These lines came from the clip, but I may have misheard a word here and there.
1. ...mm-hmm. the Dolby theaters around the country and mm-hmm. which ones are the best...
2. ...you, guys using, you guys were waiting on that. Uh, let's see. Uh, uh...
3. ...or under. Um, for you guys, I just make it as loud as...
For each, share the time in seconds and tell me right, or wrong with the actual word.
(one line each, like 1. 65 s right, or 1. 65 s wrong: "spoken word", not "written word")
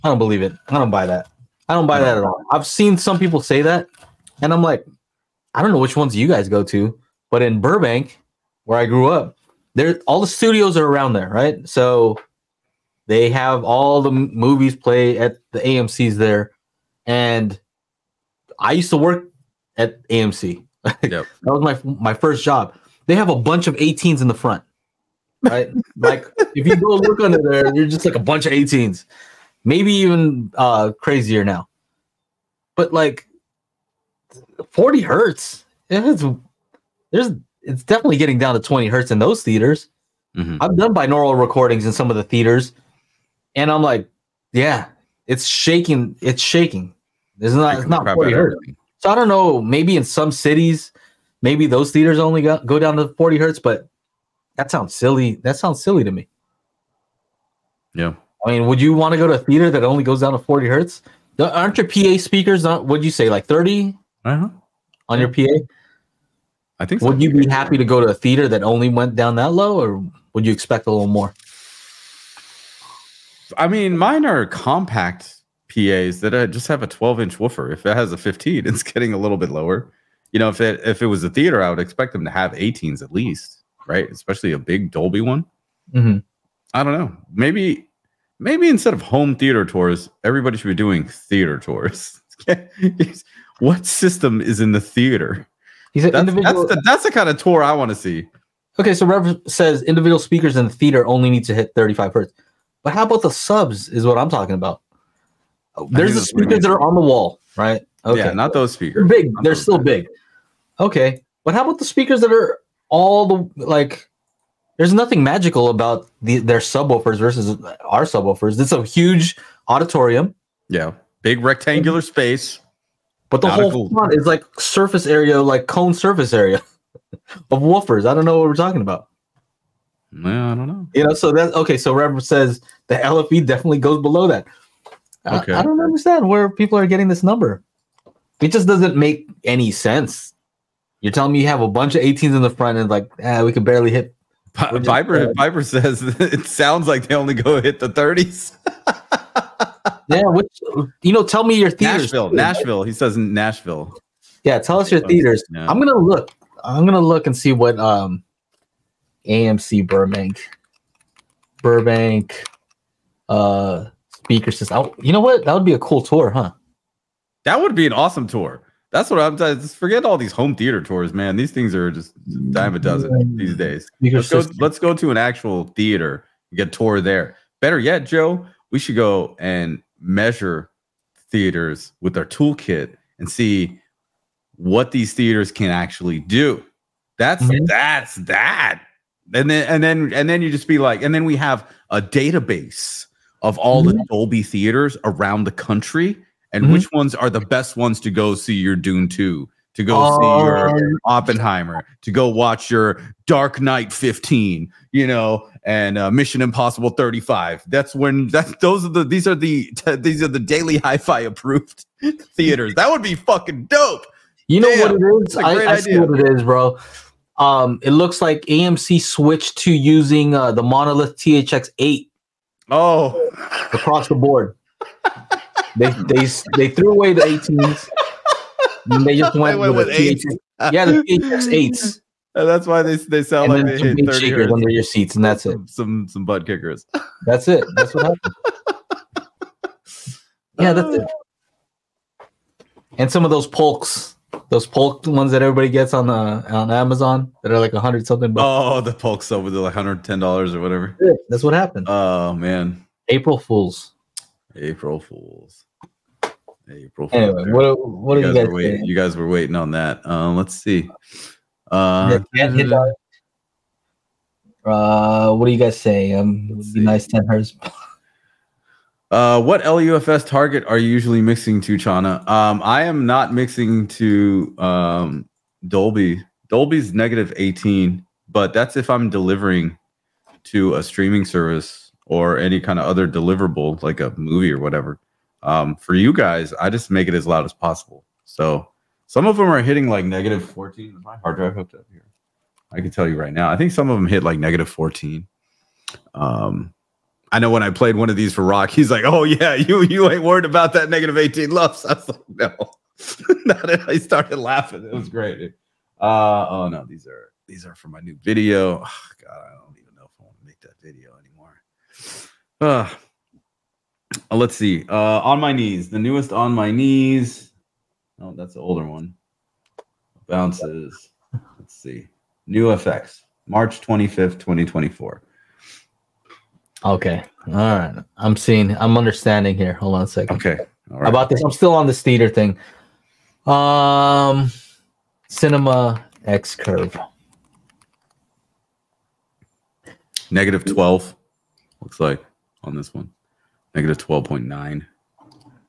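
1. 193 s right
2. 258 s wrong: "waiting", not "using"
3. 284 s wrong: "whatever", not "under".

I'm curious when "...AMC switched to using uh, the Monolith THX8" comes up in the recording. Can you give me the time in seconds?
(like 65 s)
218 s.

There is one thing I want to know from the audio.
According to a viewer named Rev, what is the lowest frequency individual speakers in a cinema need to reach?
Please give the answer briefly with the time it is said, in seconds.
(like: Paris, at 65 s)
35 hertz, at 101 s.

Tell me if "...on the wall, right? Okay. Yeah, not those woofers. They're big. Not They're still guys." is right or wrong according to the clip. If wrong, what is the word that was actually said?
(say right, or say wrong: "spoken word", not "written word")
wrong: "speakers", not "woofers".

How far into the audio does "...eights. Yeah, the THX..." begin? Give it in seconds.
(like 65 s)
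229 s.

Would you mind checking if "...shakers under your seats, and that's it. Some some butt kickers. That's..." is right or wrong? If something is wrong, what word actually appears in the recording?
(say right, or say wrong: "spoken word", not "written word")
right.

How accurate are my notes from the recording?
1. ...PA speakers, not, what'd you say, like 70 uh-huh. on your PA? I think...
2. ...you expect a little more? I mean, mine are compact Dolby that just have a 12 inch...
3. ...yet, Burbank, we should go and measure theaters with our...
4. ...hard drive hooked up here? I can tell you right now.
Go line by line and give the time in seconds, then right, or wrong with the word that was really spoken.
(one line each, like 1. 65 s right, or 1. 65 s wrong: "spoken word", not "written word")
1. 61 s wrong: "30", not "70"
2. 70 s wrong: "PAs", not "Dolby"
3. 177 s wrong: "Joe", not "Burbank"
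4. 291 s right.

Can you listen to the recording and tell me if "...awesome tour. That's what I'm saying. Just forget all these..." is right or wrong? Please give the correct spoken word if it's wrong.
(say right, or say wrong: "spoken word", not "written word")
right.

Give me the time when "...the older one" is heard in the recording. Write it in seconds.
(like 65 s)
318 s.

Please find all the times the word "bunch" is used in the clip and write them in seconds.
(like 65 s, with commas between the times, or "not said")
23 s, 28 s, 141 s.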